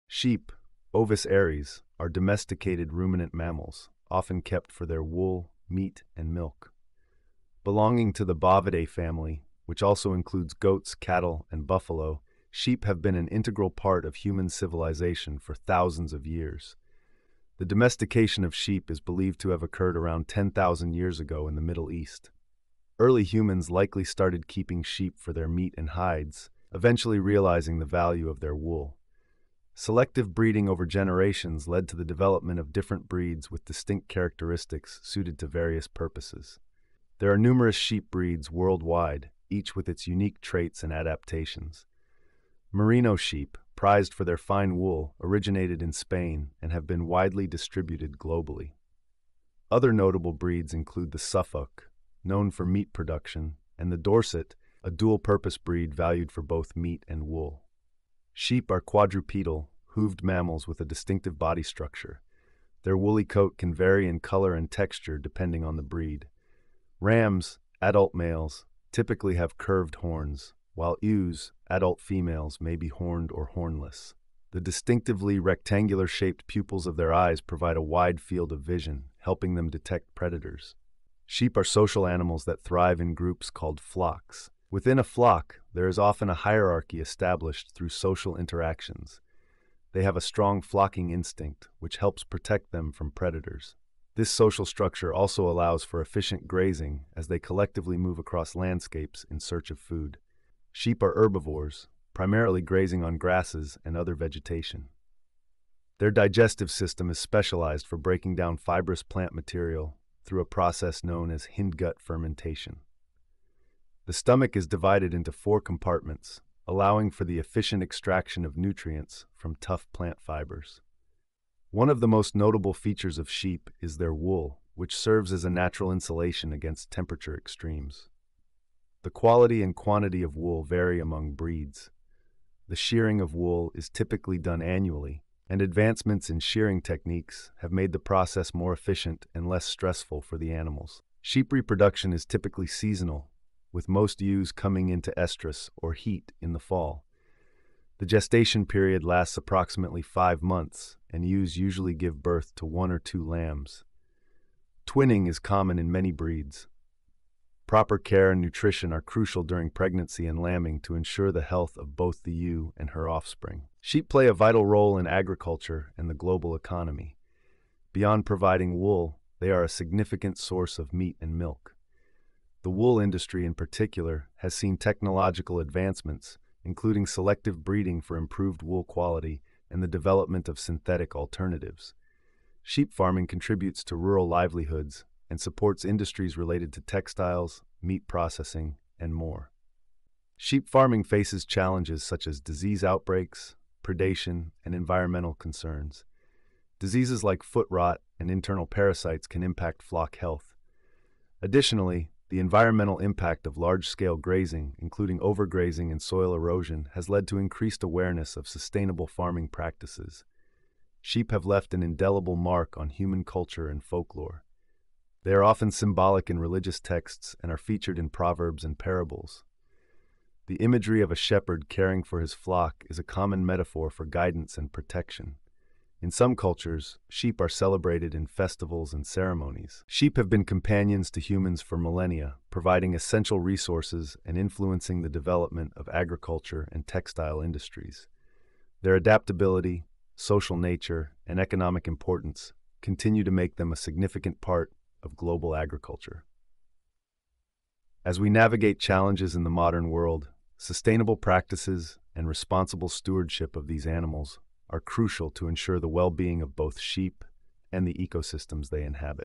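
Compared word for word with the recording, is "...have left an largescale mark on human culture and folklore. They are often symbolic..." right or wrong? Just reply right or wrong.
wrong.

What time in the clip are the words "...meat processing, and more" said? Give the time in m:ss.
3:07.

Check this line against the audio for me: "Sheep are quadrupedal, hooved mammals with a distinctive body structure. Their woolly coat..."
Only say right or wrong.
right.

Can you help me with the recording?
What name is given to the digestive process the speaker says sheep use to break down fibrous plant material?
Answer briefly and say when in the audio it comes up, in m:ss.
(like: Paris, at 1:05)
hindgut fermentation, at 1:51.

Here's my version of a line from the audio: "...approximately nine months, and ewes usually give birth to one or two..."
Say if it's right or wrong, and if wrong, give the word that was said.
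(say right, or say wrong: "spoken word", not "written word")
wrong: "five", not "nine".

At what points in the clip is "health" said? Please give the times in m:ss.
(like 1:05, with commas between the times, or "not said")
2:41, 3:20.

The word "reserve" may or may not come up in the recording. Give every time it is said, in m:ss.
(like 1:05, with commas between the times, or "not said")
not said.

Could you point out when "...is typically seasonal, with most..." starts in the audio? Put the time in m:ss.
2:22.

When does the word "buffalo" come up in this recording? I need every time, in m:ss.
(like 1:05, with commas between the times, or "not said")
0:11.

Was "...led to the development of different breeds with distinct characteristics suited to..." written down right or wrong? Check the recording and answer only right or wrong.
right.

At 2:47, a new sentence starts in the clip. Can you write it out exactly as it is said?
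Beyond providing wool, they are a significant source of meat and milk.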